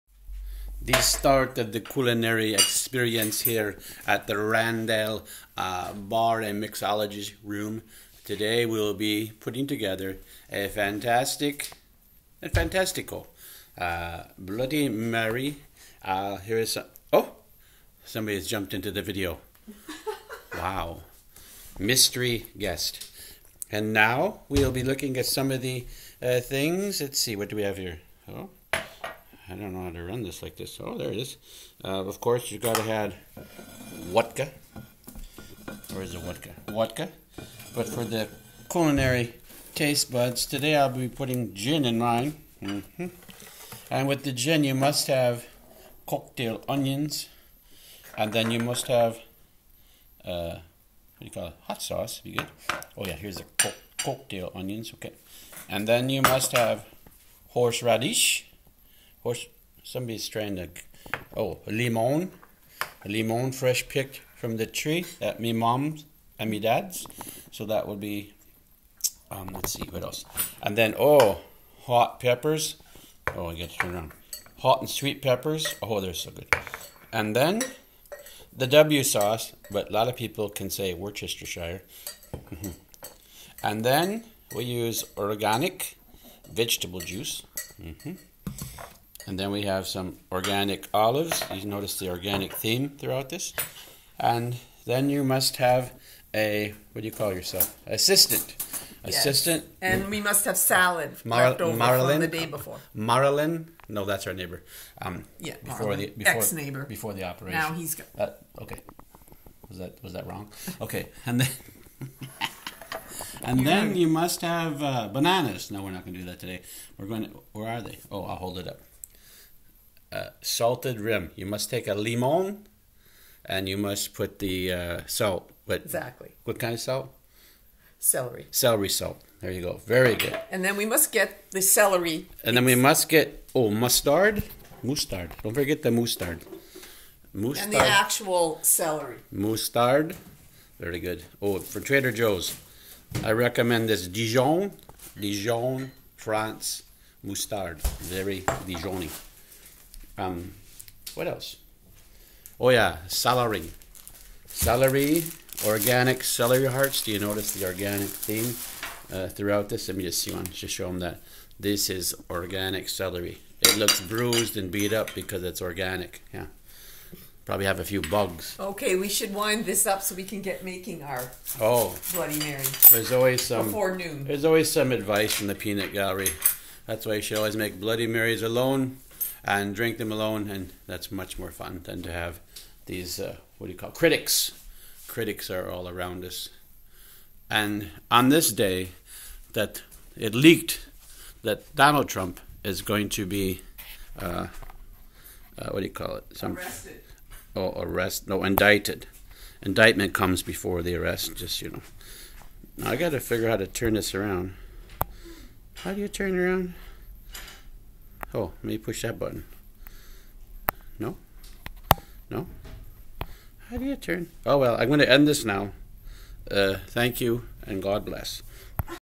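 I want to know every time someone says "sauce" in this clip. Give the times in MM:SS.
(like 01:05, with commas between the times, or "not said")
00:51, 01:19.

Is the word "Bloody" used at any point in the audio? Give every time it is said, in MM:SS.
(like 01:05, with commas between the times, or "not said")
00:14, 02:52, 02:57.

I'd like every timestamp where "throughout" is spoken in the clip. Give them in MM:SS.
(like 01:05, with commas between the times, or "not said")
01:32, 02:39.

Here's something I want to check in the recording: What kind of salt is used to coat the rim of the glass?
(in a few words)
Celery salt.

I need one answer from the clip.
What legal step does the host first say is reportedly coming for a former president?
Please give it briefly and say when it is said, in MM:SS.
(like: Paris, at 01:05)
Indicted, at 03:18.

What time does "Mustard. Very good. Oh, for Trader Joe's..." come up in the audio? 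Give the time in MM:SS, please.
02:19.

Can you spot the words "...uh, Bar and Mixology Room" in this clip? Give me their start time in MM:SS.
00:05.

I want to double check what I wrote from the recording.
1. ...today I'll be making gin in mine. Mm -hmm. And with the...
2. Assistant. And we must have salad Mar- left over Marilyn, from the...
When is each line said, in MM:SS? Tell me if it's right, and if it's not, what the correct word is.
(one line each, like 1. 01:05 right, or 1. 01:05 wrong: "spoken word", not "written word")
1. 00:40 wrong: "putting", not "making"
2. 01:39 right.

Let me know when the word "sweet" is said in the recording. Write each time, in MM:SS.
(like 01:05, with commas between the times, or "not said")
01:14.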